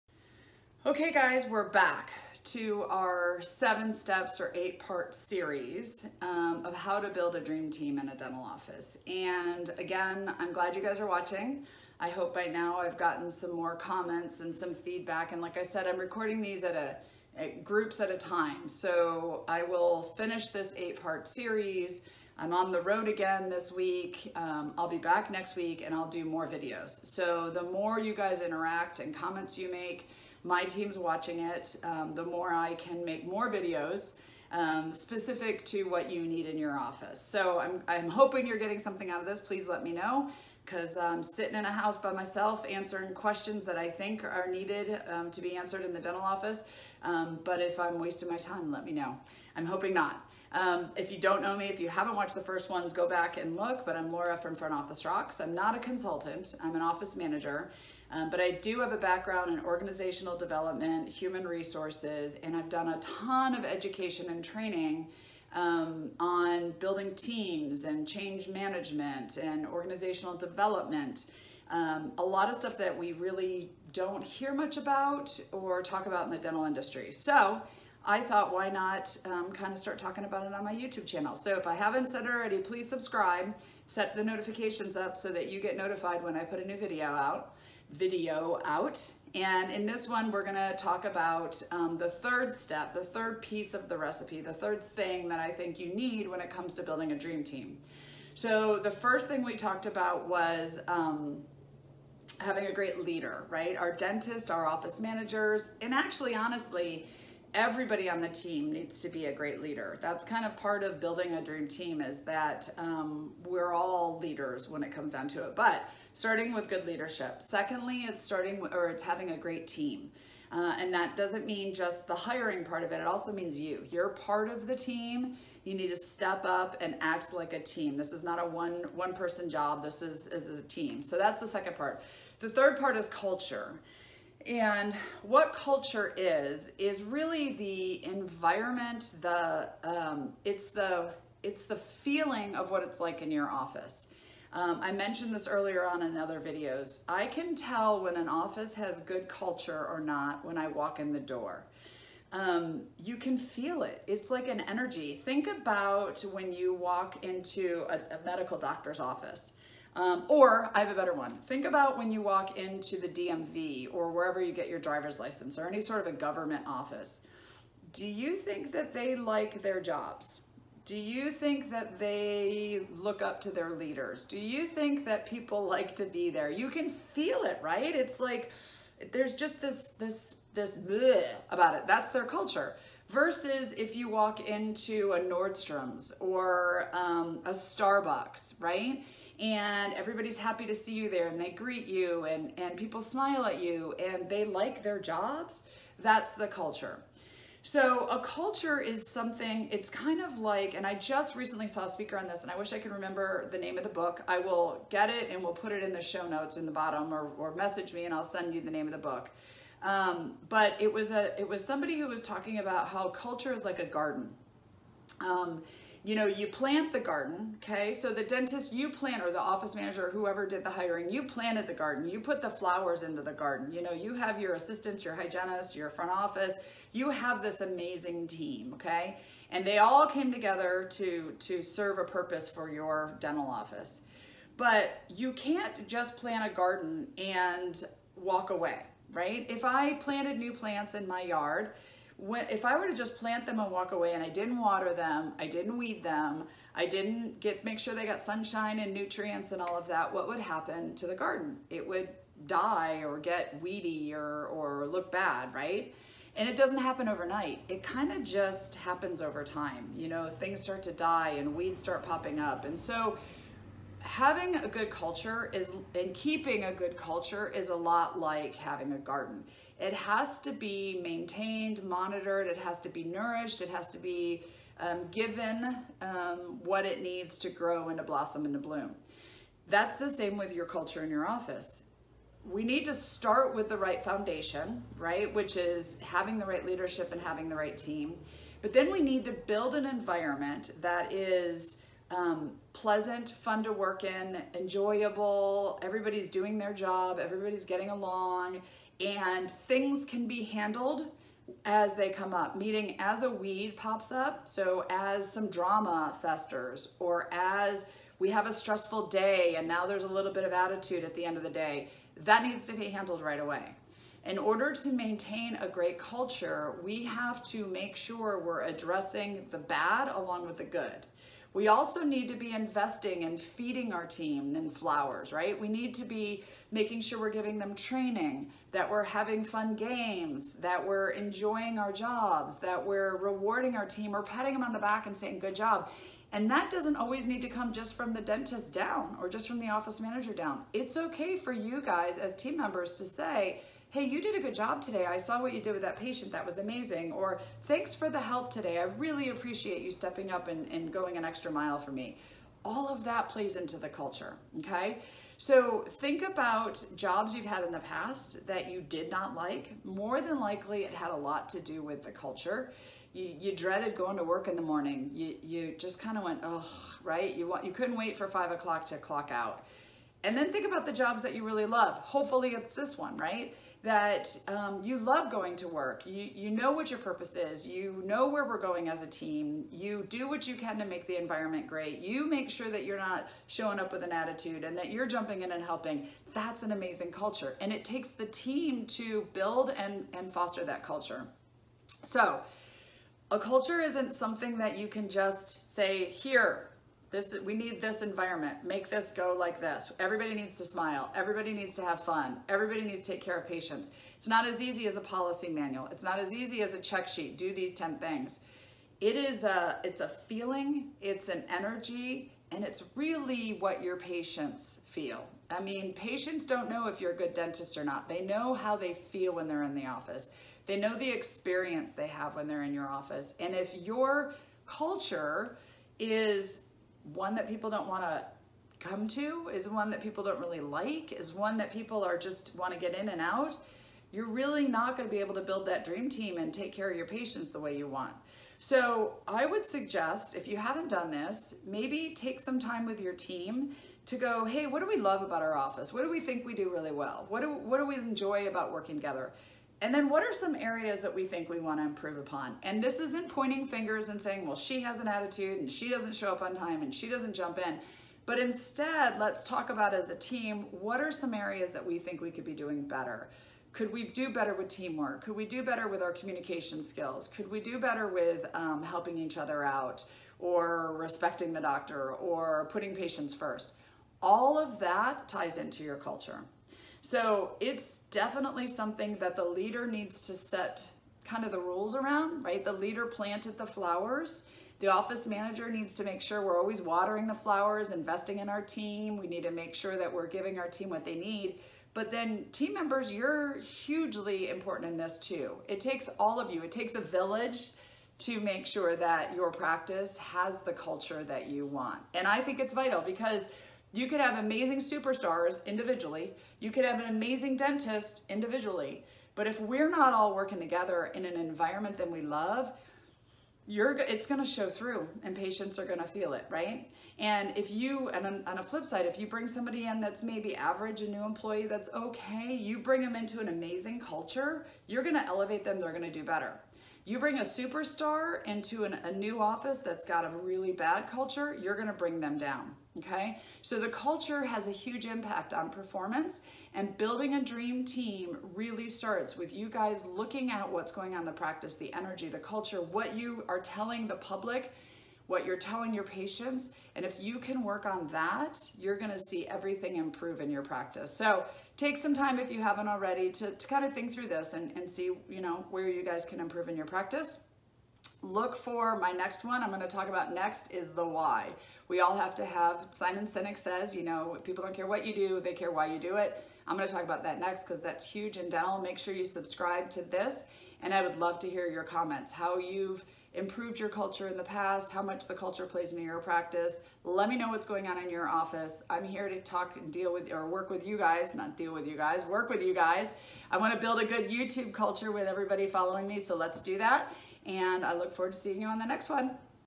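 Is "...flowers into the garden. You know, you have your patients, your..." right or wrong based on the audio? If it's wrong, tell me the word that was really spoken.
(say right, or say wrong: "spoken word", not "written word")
wrong: "assistants", not "patients".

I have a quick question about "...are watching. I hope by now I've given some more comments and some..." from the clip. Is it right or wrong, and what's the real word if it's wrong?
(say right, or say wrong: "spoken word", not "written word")
wrong: "gotten", not "given".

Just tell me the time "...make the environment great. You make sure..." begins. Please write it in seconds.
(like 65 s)
380 s.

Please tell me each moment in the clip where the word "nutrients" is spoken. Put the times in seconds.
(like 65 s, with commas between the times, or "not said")
248 s.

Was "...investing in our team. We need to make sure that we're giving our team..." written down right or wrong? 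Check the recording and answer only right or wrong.
right.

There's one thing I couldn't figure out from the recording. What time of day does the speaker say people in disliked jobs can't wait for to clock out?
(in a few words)
five o'clock.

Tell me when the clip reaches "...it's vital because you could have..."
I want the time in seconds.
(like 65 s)
502 s.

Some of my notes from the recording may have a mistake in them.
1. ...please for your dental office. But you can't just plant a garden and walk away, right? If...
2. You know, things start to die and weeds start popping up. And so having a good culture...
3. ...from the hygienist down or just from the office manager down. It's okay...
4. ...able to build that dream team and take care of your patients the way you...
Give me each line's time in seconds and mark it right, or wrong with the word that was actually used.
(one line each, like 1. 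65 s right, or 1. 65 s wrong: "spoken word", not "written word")
1. 232 s wrong: "purpose", not "please"
2. 259 s right
3. 337 s wrong: "dentist", not "hygienist"
4. 435 s right.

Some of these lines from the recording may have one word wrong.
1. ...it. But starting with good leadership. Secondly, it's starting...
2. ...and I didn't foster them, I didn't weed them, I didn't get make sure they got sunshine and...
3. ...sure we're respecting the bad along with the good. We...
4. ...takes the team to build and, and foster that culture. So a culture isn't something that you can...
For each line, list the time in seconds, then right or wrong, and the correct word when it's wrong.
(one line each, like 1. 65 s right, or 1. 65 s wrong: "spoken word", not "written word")
1. 115 s right
2. 244 s wrong: "water", not "foster"
3. 317 s wrong: "addressing", not "respecting"
4. 387 s right.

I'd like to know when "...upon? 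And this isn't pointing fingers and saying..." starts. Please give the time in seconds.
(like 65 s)
452 s.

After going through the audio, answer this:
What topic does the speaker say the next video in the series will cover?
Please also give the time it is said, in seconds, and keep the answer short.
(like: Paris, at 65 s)
the why, at 560 s.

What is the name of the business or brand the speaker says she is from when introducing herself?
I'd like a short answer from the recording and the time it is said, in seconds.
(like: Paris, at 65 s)
Front Office Rocks, at 54 s.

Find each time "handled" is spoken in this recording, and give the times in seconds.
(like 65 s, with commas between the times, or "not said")
300 s, 312 s.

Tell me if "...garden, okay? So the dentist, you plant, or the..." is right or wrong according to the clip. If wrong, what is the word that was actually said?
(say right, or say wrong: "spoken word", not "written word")
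right.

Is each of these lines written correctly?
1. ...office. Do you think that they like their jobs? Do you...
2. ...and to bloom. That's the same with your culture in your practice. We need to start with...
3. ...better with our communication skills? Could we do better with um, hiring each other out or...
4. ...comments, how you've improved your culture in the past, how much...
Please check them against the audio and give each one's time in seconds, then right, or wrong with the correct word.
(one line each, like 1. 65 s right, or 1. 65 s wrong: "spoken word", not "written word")
1. 166 s right
2. 278 s wrong: "office", not "practice"
3. 465 s wrong: "helping", not "hiring"
4. 571 s right.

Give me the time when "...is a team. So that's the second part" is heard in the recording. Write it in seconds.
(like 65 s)
130 s.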